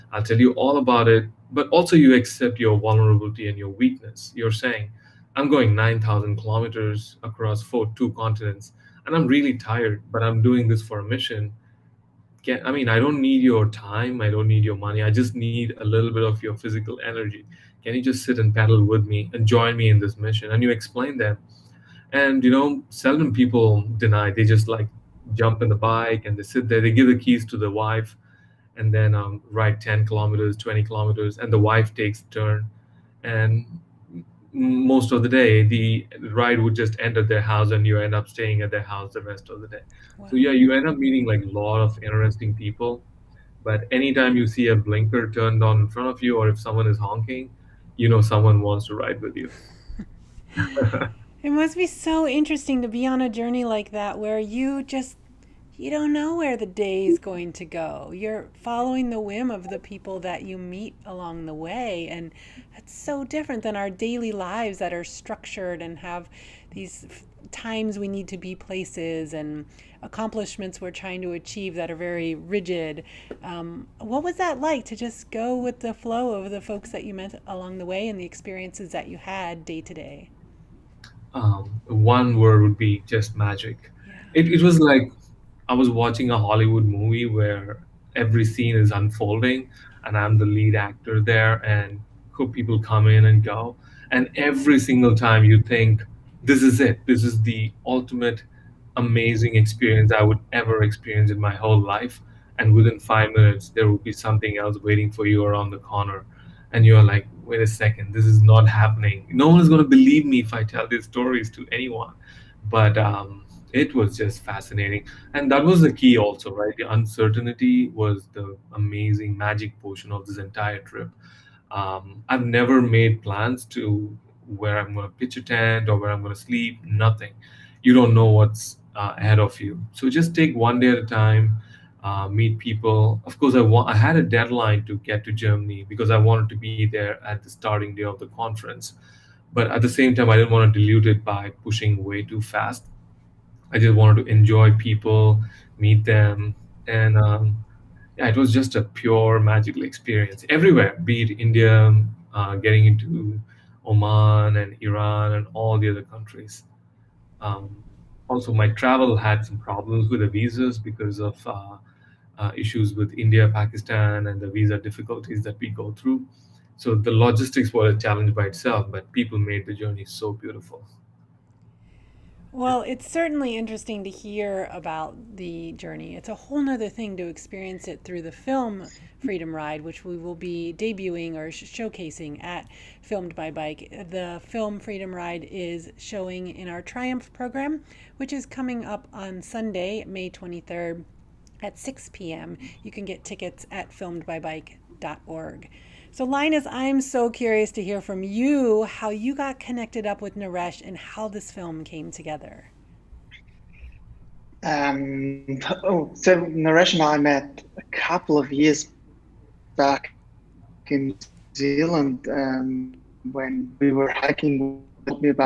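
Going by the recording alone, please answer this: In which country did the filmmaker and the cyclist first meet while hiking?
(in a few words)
New Zealand.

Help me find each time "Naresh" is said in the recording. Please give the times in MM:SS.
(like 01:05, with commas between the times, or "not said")
03:20, 03:26.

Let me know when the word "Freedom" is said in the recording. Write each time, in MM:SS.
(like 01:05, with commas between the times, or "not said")
02:59, 03:04.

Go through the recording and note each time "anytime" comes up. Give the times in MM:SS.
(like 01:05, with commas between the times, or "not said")
00:43.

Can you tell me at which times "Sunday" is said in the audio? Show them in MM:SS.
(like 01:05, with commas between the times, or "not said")
03:09.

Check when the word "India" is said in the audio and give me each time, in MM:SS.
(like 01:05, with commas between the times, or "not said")
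02:31, 02:43.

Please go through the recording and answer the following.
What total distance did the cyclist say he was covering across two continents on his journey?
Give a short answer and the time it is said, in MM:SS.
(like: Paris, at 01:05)
9,000 kilometers, at 00:05.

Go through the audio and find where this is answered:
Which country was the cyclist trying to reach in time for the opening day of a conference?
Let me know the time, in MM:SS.
02:15.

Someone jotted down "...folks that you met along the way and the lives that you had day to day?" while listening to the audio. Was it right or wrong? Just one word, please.
wrong.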